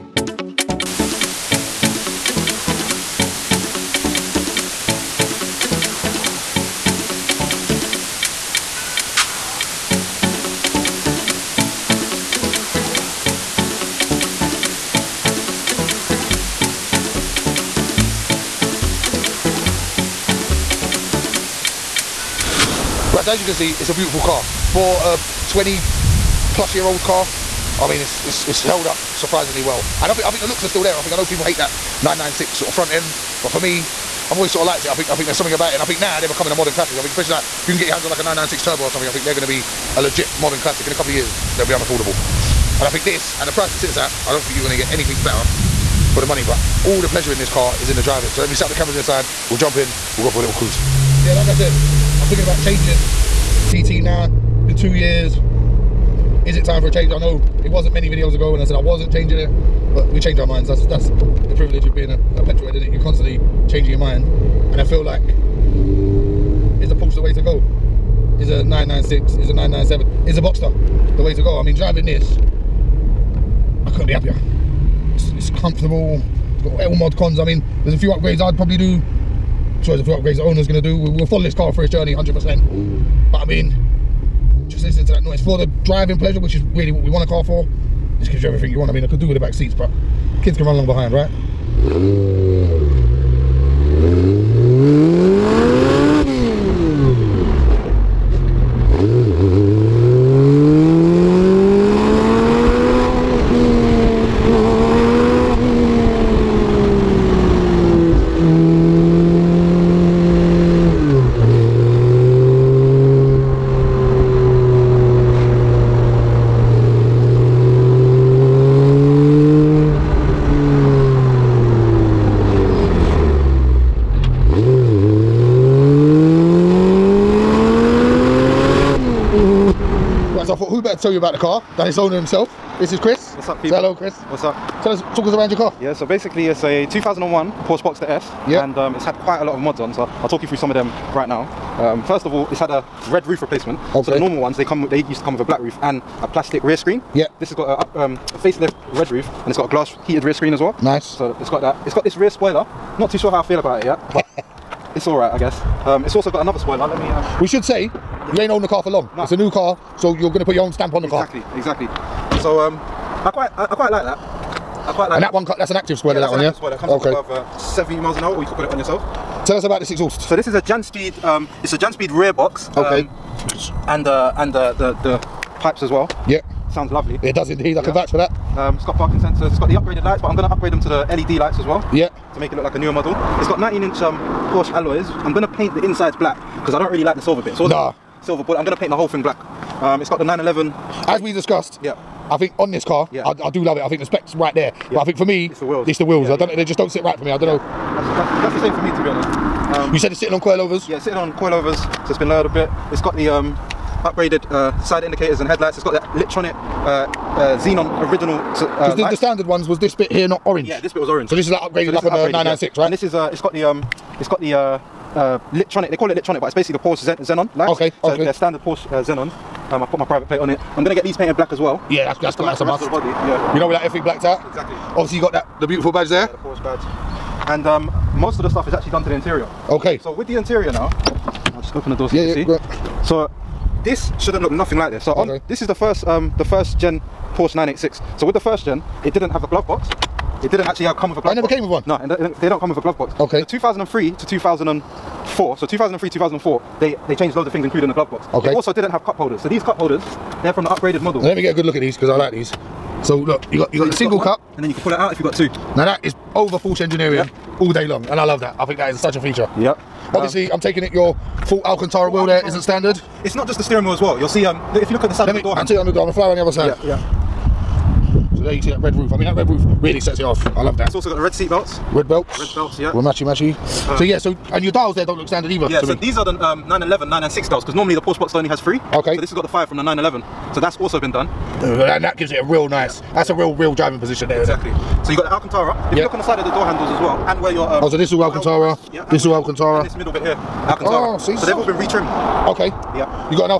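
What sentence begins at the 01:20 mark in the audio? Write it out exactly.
We, will follow this car for its journey 100%.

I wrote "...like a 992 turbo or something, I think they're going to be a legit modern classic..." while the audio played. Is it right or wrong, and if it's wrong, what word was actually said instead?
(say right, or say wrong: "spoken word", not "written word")
wrong: "996", not "992".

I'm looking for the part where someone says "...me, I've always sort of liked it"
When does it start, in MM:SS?
00:33.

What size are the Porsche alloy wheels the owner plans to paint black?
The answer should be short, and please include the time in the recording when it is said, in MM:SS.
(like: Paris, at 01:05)
19 inch, at 03:03.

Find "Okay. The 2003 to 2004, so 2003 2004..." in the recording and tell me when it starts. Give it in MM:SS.
04:03.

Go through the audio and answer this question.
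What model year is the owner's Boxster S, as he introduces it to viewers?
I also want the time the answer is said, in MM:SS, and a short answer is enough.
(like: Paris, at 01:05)
2001, at 02:16.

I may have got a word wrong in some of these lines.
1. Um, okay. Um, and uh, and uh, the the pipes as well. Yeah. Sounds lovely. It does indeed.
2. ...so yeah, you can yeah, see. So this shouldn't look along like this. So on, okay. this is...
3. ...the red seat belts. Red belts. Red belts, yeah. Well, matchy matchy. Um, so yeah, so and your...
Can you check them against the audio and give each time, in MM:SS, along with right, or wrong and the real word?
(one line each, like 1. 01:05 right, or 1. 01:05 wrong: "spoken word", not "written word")
1. 02:52 right
2. 03:52 wrong: "nothing", not "along"
3. 04:31 right.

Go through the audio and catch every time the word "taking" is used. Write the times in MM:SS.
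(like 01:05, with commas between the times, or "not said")
04:20.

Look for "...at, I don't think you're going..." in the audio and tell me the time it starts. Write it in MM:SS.
00:43.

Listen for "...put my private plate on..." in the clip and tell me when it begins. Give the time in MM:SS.
03:39.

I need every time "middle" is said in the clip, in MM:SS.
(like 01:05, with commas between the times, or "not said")
04:49.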